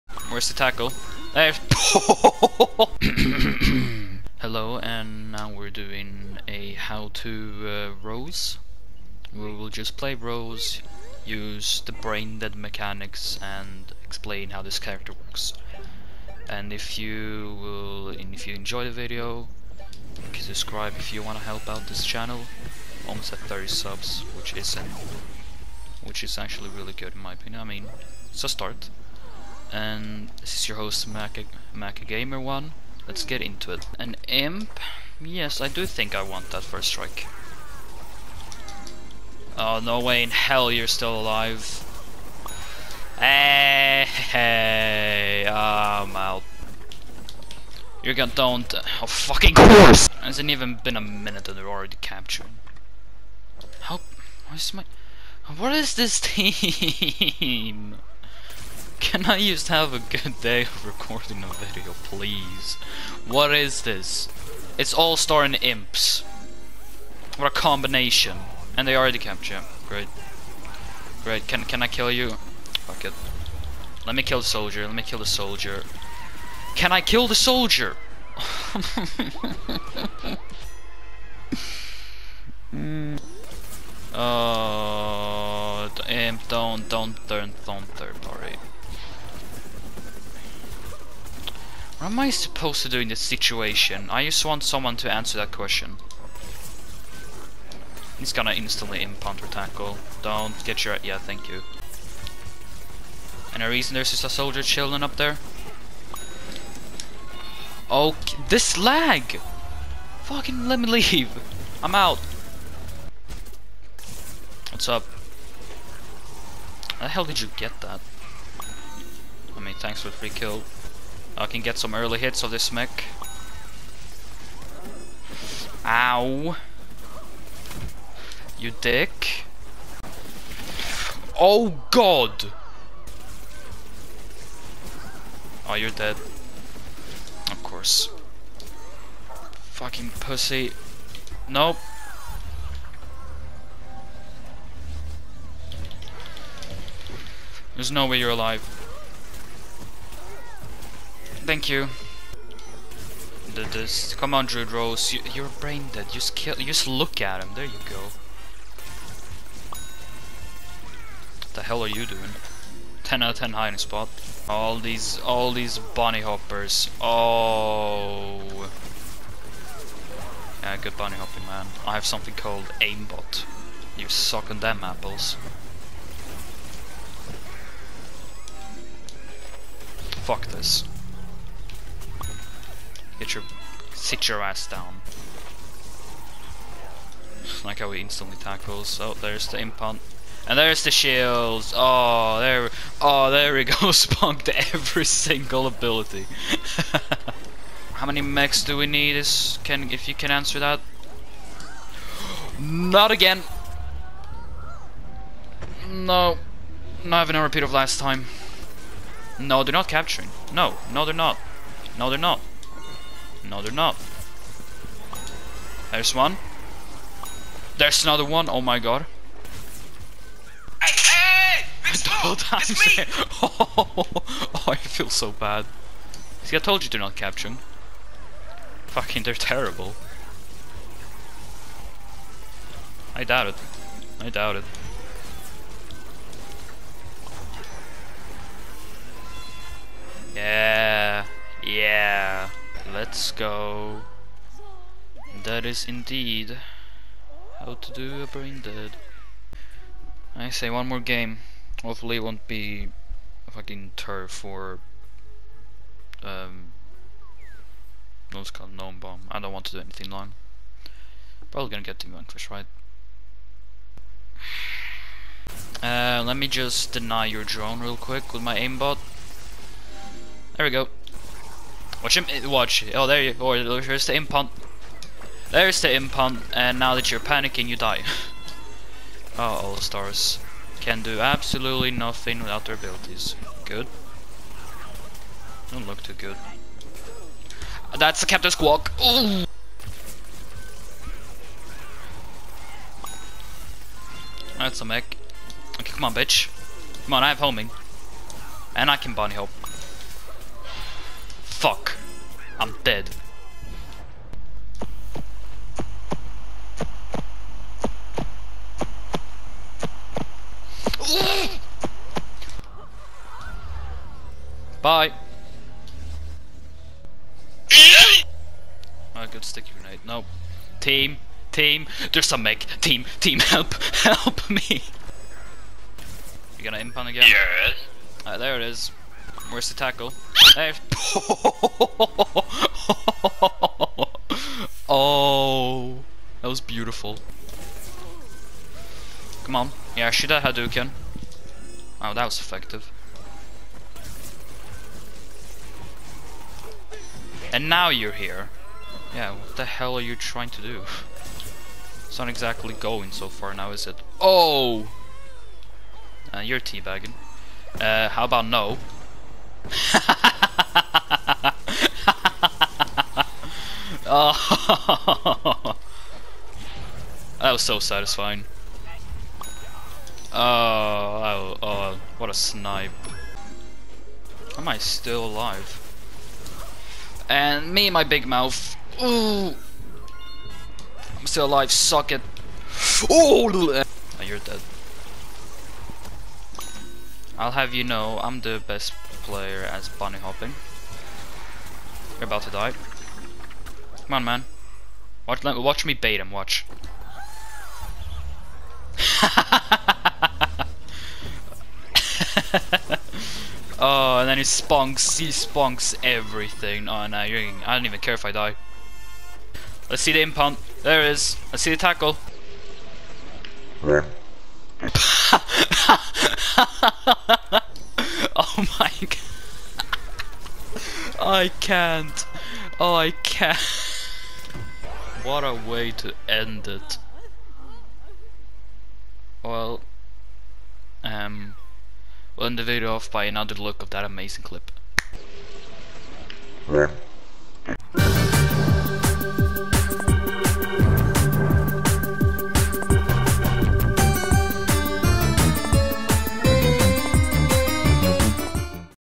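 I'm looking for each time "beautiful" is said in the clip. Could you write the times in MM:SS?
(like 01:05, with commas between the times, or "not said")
05:36.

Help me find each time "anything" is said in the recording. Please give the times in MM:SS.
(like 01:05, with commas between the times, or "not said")
04:19.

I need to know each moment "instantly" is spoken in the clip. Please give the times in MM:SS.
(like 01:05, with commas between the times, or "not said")
01:38, 03:08.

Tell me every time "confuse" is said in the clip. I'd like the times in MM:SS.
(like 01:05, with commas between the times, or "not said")
not said.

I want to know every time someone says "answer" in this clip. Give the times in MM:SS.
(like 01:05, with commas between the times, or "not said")
01:35, 03:20.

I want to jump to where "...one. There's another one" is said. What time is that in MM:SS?
03:36.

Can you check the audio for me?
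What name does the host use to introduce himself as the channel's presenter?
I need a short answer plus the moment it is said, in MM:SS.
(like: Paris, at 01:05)
Maka, at 00:31.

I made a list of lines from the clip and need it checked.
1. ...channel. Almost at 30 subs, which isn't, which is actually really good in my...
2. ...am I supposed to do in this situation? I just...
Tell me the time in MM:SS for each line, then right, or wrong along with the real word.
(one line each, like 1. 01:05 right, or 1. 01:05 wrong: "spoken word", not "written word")
1. 00:22 right
2. 01:32 right.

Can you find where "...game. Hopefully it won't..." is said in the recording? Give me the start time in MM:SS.
04:10.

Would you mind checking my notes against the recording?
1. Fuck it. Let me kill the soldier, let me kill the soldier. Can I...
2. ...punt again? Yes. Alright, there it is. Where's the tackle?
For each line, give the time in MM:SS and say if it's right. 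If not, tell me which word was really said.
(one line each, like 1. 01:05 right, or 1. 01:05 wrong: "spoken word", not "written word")
1. 01:12 right
2. 05:26 right.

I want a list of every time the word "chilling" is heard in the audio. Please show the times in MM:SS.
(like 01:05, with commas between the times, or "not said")
01:44.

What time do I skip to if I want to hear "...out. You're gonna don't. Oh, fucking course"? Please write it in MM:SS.
00:46.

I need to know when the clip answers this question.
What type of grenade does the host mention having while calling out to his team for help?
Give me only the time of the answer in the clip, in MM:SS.
05:19.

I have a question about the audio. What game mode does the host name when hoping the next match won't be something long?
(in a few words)
Gnome bomb.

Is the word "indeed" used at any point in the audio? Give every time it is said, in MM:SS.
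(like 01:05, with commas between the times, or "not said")
04:05.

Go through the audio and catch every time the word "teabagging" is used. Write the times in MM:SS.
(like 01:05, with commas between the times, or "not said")
05:56.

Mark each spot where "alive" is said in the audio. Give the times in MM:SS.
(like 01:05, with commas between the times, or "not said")
00:41, 02:28, 06:15, 06:21.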